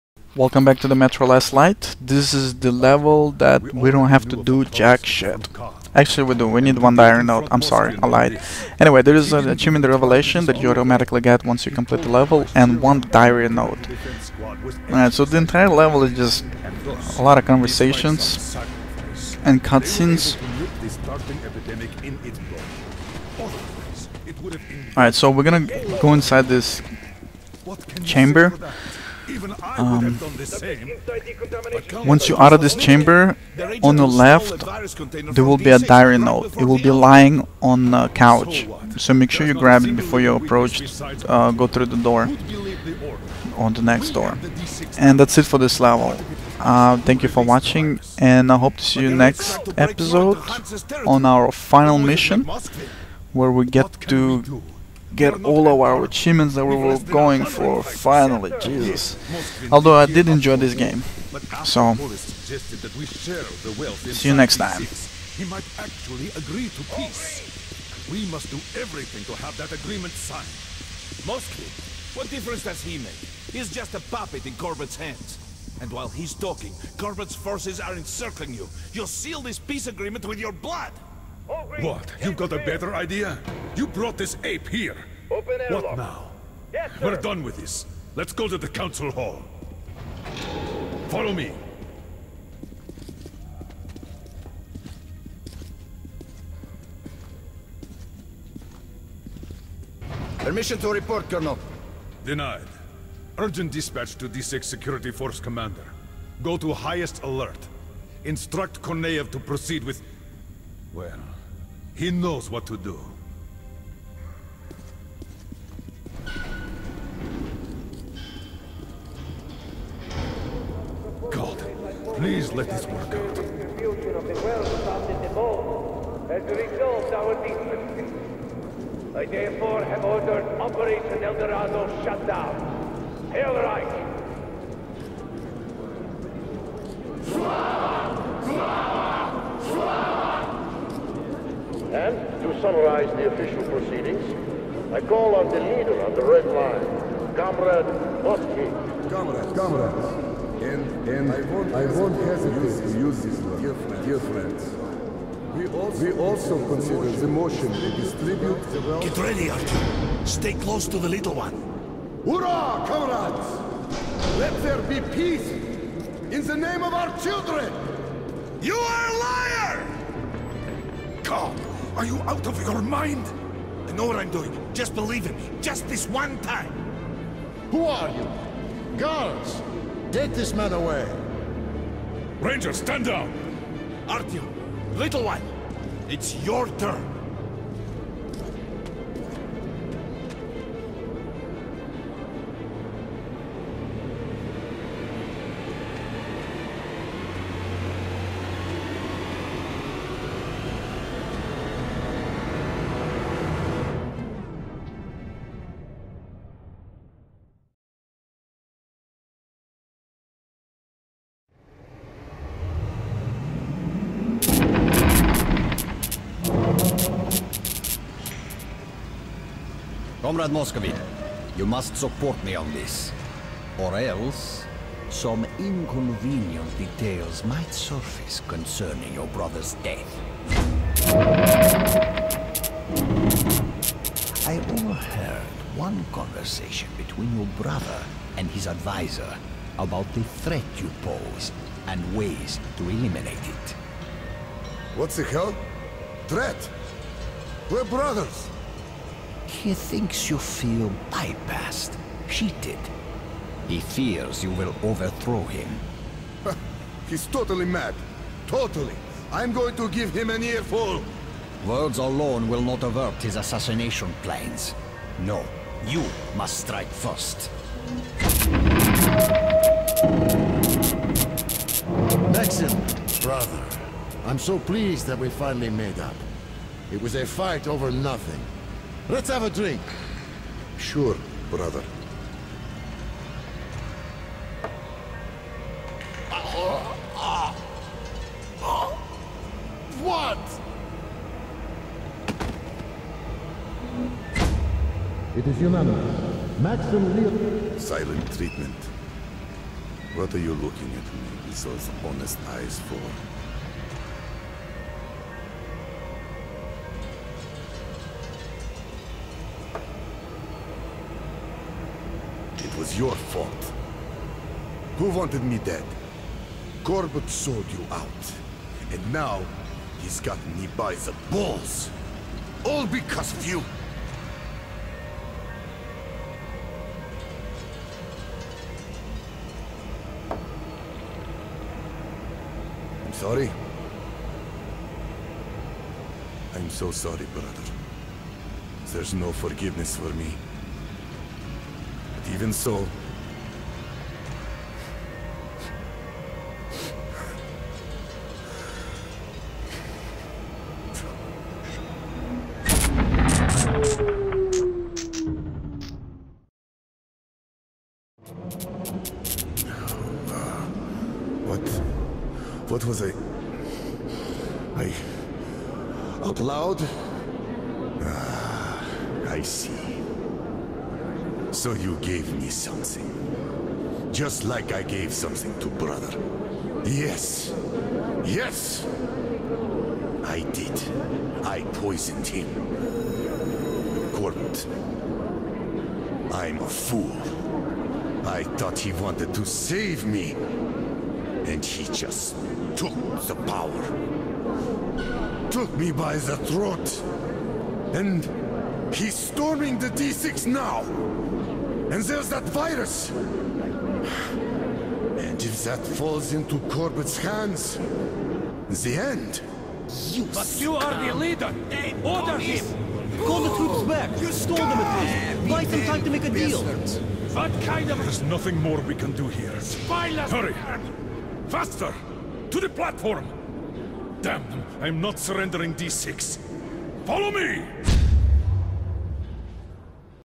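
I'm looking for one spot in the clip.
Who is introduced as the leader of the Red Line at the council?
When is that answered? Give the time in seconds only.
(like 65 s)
147 s.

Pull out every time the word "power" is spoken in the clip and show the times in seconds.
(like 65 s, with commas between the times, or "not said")
393 s.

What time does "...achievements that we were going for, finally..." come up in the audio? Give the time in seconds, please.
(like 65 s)
56 s.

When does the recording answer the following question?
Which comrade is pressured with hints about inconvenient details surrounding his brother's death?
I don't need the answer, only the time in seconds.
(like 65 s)
220 s.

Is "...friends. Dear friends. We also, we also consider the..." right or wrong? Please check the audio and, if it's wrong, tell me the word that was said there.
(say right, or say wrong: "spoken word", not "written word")
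right.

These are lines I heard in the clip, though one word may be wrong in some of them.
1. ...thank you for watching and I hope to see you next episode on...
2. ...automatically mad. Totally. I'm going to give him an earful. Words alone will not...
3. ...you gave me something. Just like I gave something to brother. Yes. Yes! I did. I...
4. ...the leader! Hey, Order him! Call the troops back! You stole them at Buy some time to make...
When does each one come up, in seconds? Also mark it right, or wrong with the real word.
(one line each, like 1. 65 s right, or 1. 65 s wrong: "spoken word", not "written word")
1. 46 s right
2. 257 s wrong: "totally", not "automatically"
3. 371 s right
4. 411 s right.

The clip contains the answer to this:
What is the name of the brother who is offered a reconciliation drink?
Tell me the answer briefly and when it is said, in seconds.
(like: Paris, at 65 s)
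Maxim, at 272 s.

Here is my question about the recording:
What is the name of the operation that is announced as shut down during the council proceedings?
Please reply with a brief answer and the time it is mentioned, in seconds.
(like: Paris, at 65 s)
Operation Eldorado, at 130 s.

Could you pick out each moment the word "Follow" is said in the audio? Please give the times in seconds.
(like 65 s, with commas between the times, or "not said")
91 s, 427 s.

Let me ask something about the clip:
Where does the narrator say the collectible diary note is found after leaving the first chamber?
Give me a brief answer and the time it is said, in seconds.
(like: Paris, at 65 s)
On a couch, at 36 s.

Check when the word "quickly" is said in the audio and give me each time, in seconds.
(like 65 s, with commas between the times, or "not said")
not said.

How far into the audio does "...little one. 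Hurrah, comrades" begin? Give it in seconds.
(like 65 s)
161 s.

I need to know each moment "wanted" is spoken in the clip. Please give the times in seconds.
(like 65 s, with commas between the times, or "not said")
315 s, 388 s.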